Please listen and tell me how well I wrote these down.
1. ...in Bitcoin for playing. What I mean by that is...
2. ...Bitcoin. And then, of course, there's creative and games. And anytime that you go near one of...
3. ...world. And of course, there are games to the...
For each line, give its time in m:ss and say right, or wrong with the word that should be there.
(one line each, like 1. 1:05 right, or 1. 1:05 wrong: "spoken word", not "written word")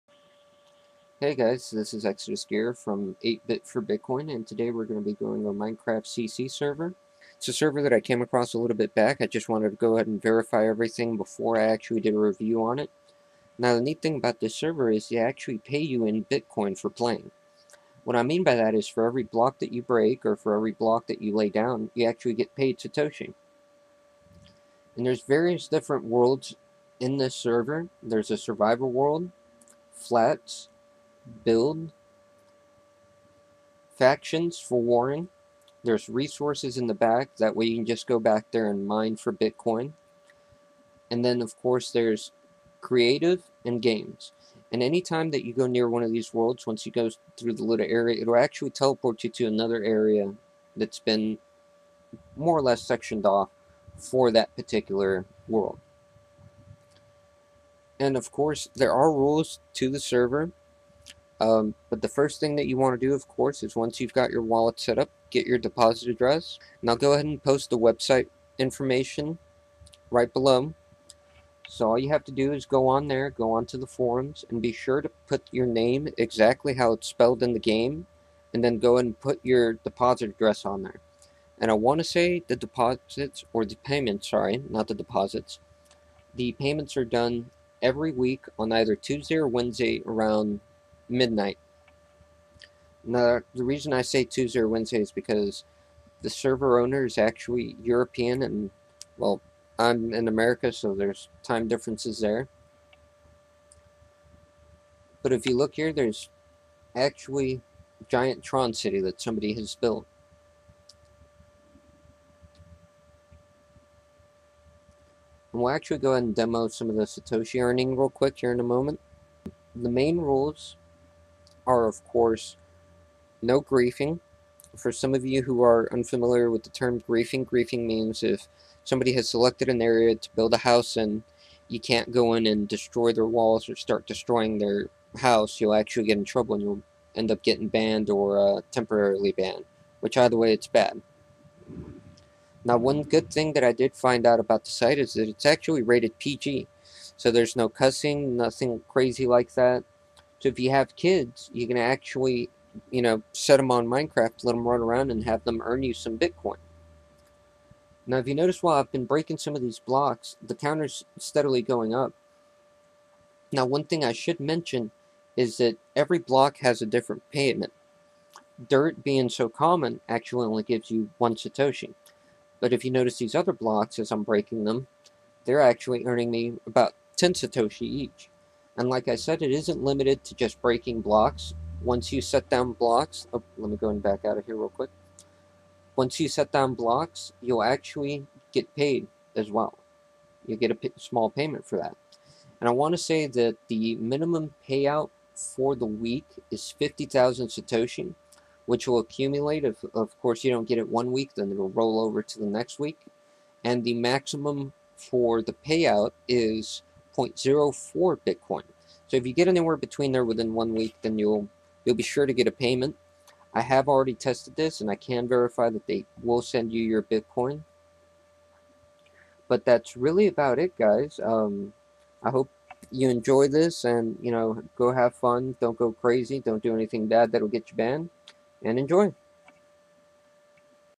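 1. 0:16 right
2. 0:39 right
3. 0:55 wrong: "rules", not "games".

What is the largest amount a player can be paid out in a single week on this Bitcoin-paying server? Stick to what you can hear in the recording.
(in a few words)
0.04 Bitcoin.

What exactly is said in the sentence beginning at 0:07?
It's a server that I came across a little bit back.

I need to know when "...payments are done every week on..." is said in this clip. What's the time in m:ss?
1:26.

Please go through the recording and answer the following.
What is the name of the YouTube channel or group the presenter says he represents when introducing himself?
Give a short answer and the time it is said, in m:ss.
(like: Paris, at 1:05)
8-Bit for Bitcoin, at 0:03.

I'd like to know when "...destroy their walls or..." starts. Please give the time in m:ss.
2:12.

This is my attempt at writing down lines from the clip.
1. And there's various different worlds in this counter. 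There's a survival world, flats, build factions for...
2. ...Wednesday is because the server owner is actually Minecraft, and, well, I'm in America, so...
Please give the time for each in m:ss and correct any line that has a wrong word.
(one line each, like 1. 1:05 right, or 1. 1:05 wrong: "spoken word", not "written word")
1. 0:24 wrong: "server", not "counter"
2. 1:34 wrong: "European", not "Minecraft".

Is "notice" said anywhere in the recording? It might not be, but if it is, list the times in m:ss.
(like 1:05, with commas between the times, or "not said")
2:38, 2:52.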